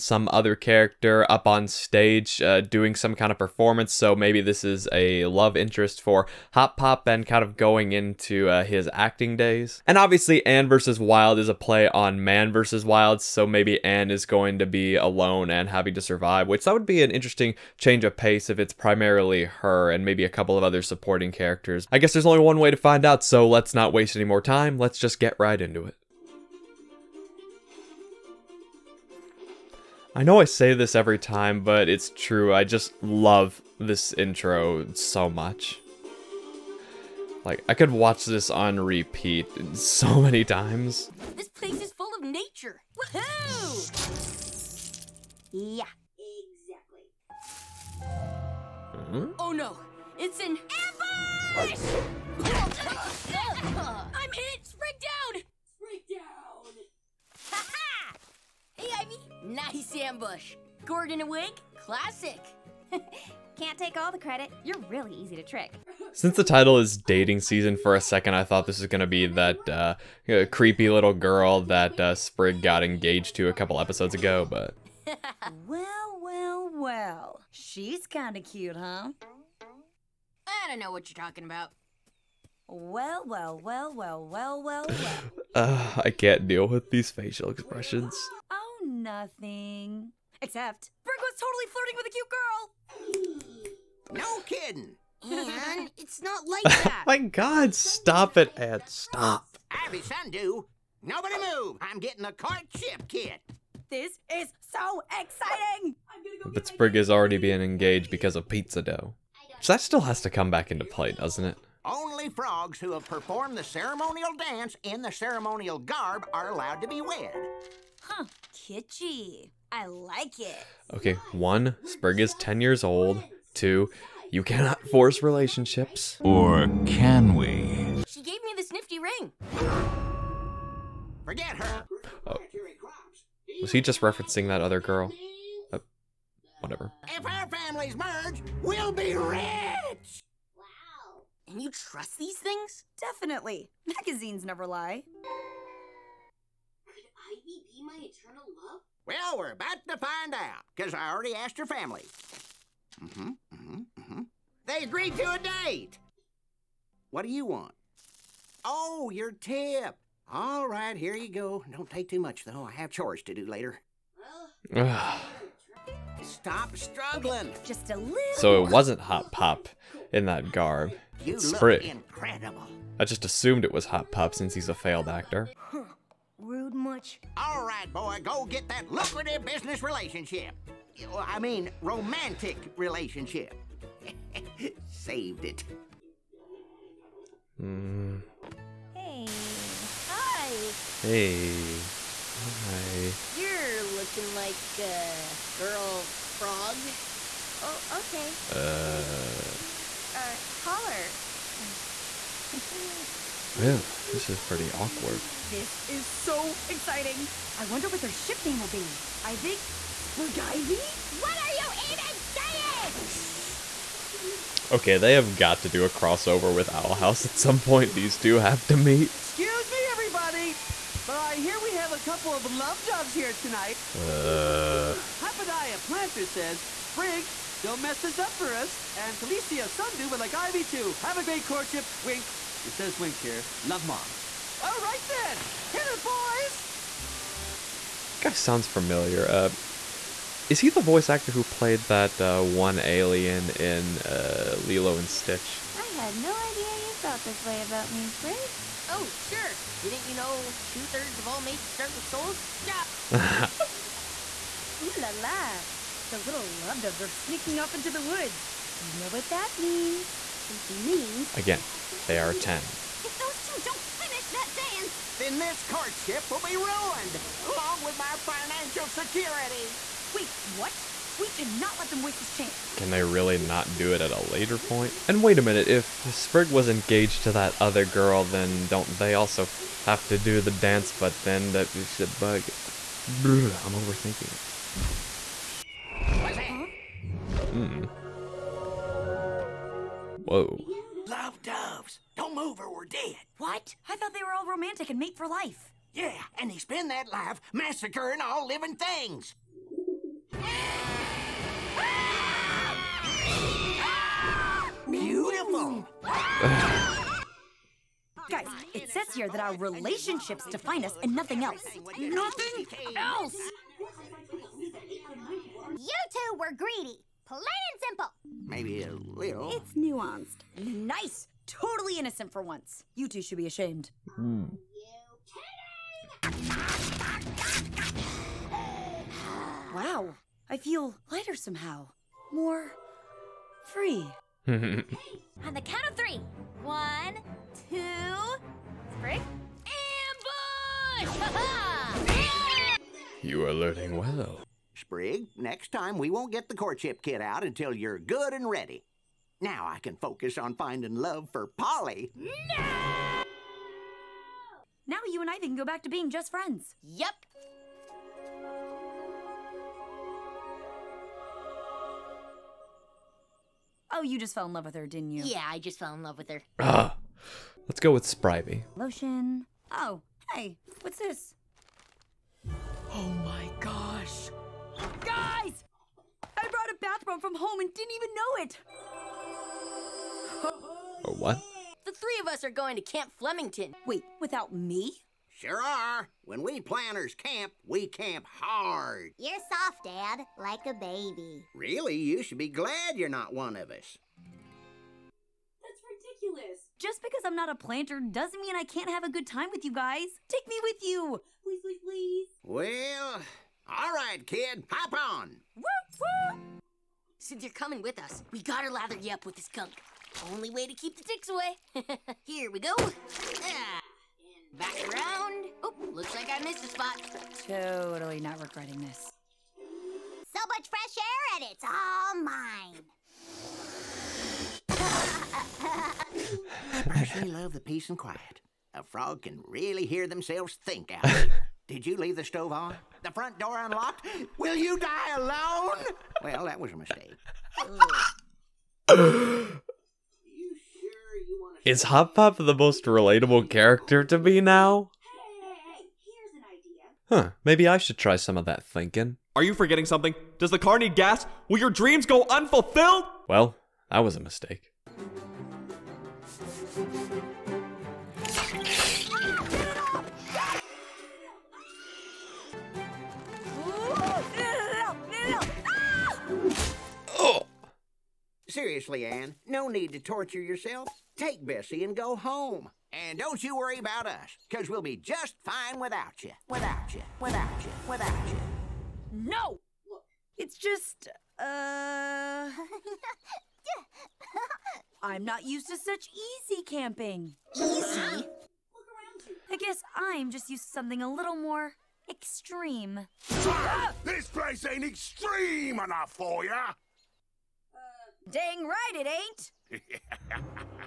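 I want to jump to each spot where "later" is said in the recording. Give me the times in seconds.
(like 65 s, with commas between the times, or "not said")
163 s, 274 s.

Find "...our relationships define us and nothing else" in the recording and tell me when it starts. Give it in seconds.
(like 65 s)
309 s.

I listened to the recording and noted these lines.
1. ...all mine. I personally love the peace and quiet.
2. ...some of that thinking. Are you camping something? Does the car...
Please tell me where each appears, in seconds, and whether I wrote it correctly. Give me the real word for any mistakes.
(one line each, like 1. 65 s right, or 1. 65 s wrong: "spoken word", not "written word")
1. 421 s right
2. 448 s wrong: "forgetting", not "camping".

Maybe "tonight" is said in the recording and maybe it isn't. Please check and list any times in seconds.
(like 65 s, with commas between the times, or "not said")
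223 s.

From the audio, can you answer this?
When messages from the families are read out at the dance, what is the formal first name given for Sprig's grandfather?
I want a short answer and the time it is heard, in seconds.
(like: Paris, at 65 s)
Hopadiah, at 225 s.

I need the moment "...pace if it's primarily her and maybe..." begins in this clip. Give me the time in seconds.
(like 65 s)
18 s.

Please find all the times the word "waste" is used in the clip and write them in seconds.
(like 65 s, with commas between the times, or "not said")
23 s, 272 s.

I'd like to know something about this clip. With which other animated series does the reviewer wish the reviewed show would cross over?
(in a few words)
Owl House.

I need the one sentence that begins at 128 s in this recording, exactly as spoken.
She gave me this nifty ring.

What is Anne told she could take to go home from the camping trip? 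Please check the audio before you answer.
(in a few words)
Bessie.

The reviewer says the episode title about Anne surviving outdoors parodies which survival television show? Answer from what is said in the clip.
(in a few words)
Man versus Wild.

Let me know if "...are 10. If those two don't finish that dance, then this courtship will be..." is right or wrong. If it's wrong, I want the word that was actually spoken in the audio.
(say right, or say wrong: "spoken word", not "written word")
right.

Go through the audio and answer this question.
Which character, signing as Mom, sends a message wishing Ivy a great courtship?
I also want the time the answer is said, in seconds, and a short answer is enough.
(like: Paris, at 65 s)
Felicia Sundew, at 229 s.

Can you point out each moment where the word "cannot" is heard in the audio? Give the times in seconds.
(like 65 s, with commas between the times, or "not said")
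124 s, 271 s.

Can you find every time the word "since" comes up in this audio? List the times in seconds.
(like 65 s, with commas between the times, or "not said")
66 s, 174 s, 407 s.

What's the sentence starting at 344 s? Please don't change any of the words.
Sprig, next time we won't get the courtship kit out until you're good and ready.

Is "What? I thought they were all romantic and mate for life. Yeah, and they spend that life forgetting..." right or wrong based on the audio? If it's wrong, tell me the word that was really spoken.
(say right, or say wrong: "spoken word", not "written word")
wrong: "massacring", not "forgetting".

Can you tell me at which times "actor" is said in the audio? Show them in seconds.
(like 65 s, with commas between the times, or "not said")
175 s, 241 s.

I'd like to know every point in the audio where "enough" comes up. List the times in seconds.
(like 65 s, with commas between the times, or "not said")
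495 s.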